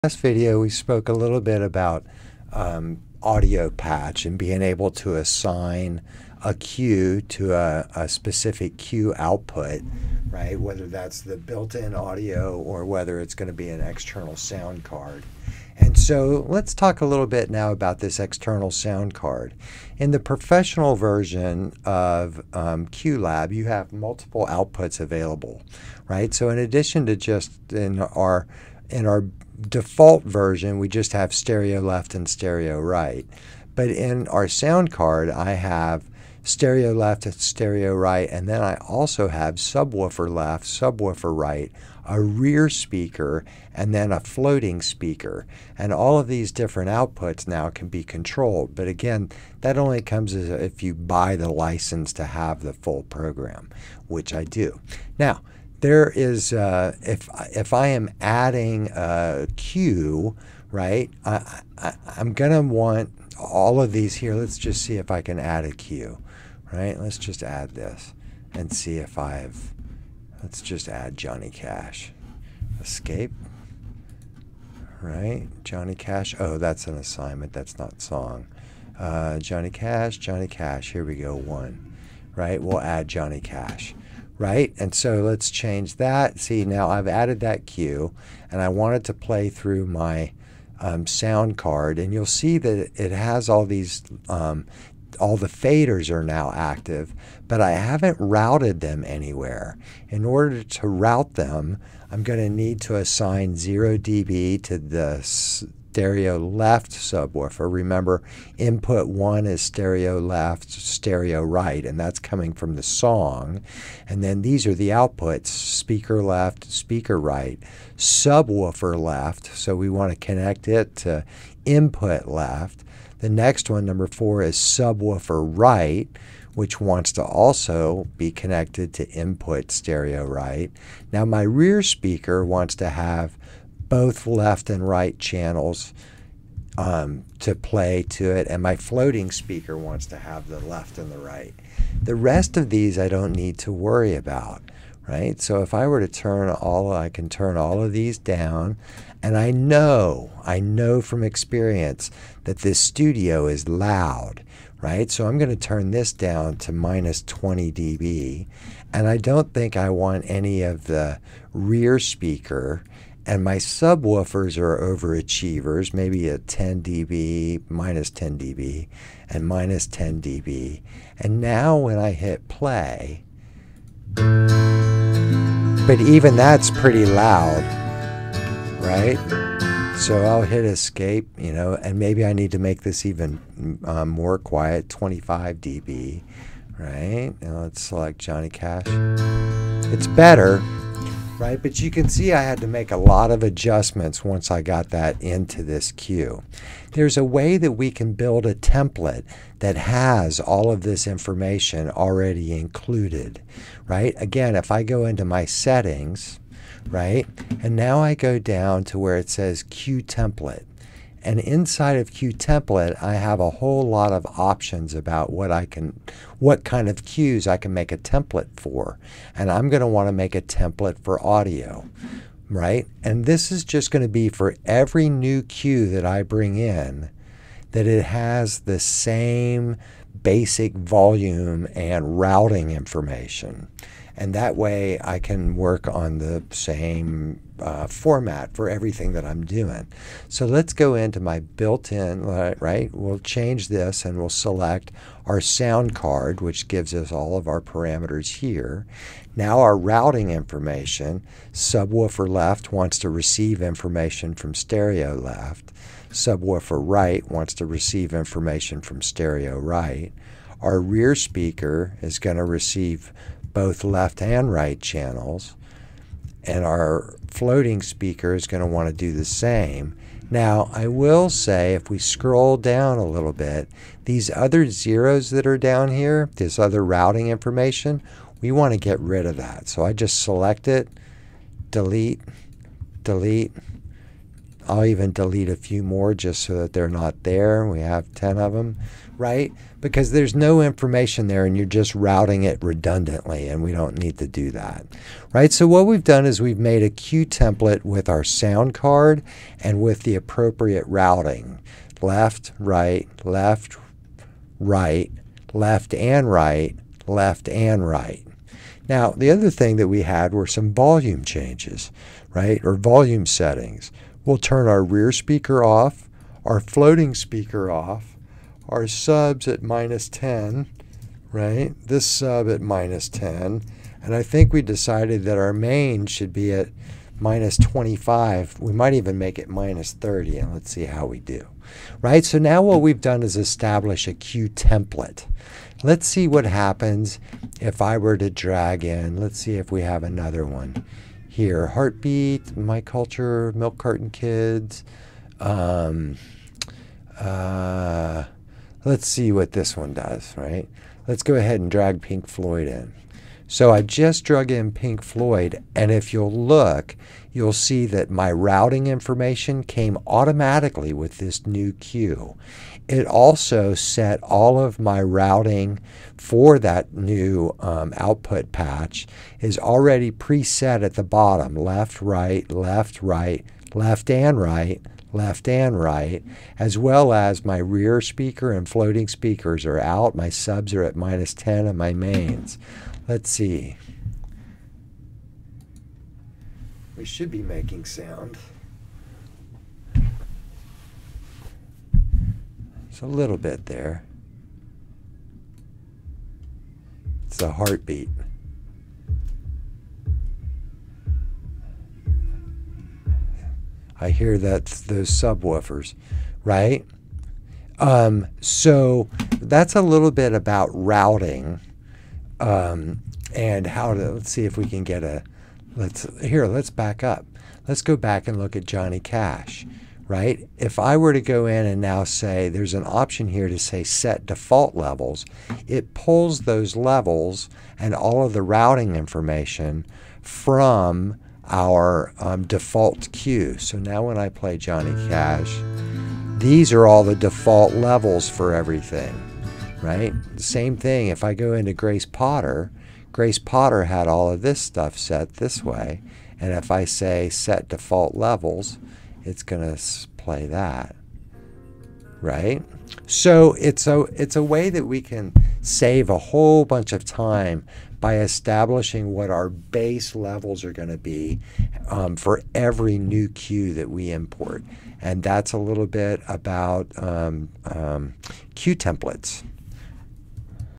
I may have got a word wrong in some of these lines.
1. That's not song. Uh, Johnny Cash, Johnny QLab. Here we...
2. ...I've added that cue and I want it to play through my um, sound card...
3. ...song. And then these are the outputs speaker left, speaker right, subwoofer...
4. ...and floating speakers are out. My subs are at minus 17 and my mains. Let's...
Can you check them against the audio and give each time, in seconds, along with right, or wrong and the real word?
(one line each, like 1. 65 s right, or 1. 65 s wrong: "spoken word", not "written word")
1. 77 s wrong: "Cash", not "QLab"
2. 86 s right
3. 112 s right
4. 378 s wrong: "10", not "17".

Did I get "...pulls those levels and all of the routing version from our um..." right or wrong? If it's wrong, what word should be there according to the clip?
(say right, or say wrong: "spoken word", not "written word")
wrong: "information", not "version".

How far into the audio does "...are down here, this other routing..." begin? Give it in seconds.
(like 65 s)
275 s.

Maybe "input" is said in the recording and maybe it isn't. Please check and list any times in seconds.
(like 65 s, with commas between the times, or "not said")
108 s, 121 s, 129 s.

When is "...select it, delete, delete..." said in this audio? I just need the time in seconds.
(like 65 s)
280 s.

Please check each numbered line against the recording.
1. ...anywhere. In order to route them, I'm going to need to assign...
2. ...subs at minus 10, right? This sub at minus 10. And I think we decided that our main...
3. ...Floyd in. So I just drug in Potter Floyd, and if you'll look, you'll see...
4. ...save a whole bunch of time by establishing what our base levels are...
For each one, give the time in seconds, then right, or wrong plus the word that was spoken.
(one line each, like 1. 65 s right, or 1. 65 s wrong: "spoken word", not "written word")
1. 99 s right
2. 318 s right
3. 352 s wrong: "Pink", not "Potter"
4. 455 s right.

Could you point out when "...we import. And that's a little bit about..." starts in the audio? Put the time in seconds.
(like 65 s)
463 s.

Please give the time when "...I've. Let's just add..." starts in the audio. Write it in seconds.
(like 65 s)
69 s.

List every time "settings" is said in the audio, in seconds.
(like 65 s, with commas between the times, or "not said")
205 s, 313 s.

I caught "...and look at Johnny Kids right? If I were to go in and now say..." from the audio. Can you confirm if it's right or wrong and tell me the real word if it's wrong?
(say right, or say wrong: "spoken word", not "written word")
wrong: "Cash", not "Kids".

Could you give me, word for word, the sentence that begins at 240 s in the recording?
So let's go into my built-in, right?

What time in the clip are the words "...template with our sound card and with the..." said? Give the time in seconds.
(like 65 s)
297 s.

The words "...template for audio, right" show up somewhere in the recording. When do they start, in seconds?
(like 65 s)
220 s.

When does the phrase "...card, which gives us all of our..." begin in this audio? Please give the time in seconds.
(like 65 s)
245 s.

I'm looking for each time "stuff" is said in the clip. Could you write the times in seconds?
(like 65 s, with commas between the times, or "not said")
444 s.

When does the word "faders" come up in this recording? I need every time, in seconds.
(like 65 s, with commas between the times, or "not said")
95 s.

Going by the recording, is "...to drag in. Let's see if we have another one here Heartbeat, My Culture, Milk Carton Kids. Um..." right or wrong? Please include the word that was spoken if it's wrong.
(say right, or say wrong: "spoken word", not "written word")
right.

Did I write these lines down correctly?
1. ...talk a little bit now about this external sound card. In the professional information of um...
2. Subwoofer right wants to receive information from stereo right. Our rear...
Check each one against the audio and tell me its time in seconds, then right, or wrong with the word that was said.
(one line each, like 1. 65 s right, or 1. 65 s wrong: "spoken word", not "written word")
1. 16 s wrong: "version", not "information"
2. 256 s right.